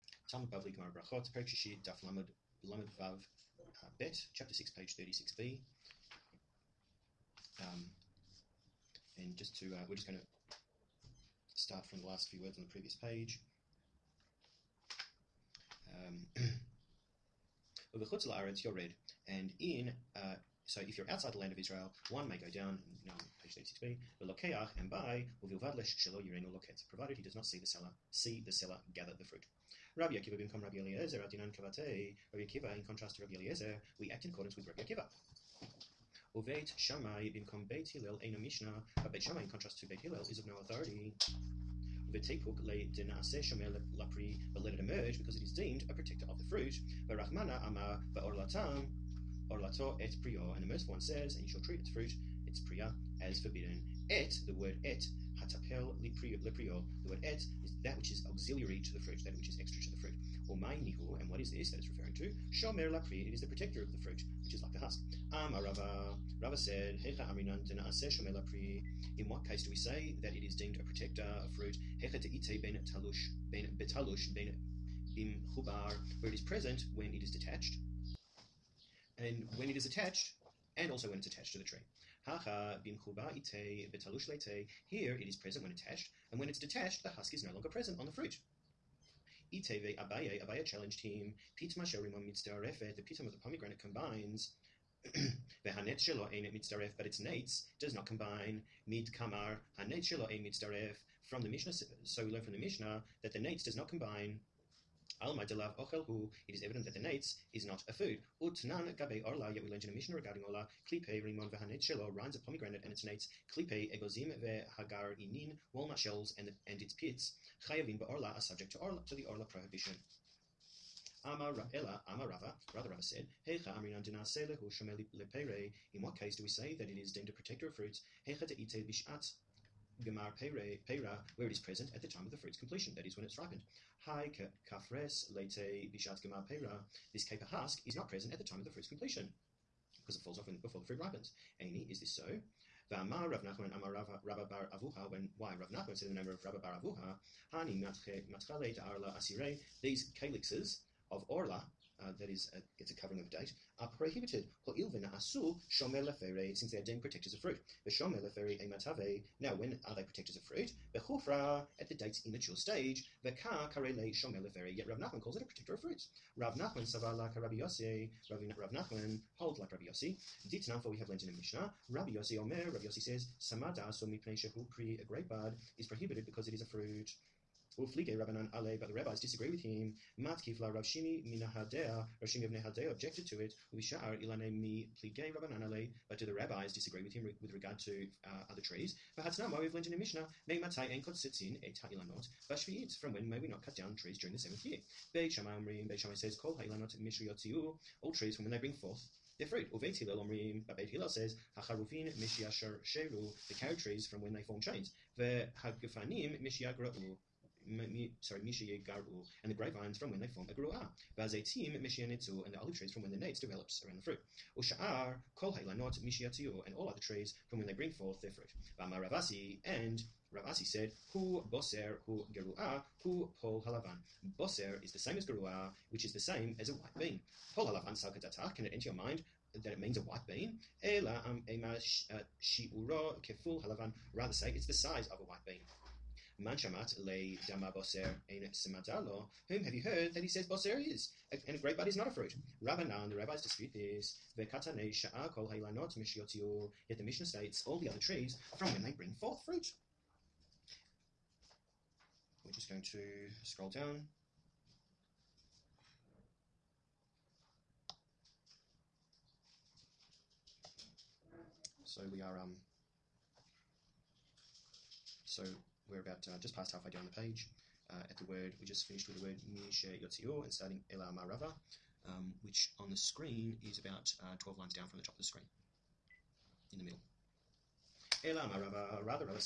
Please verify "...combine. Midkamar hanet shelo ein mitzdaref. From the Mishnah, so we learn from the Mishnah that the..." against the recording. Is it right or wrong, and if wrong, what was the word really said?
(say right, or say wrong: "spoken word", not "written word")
right.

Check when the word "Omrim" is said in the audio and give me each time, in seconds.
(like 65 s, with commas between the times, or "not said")
195 s, 200 s.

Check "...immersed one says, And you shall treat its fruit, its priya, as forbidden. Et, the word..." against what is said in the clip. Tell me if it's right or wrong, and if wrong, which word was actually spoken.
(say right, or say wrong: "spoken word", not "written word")
right.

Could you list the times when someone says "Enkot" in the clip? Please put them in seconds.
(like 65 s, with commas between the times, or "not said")
190 s.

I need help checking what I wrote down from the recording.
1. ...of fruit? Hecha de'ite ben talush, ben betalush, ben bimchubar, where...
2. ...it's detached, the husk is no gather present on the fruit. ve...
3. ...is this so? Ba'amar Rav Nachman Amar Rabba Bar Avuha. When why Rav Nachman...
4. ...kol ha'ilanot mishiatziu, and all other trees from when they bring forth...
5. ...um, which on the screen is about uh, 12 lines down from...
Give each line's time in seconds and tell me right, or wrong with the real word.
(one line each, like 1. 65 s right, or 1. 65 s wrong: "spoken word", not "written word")
1. 71 s right
2. 86 s wrong: "longer", not "gather"
3. 141 s right
4. 215 s right
5. 272 s right.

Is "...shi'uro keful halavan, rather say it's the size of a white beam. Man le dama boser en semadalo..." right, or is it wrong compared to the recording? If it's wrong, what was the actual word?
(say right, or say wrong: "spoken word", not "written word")
right.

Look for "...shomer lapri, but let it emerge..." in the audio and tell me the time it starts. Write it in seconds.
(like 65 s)
43 s.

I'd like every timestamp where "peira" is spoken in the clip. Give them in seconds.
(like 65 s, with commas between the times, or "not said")
130 s, 136 s.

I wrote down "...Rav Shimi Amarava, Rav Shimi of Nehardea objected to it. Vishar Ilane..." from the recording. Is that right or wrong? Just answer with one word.
wrong.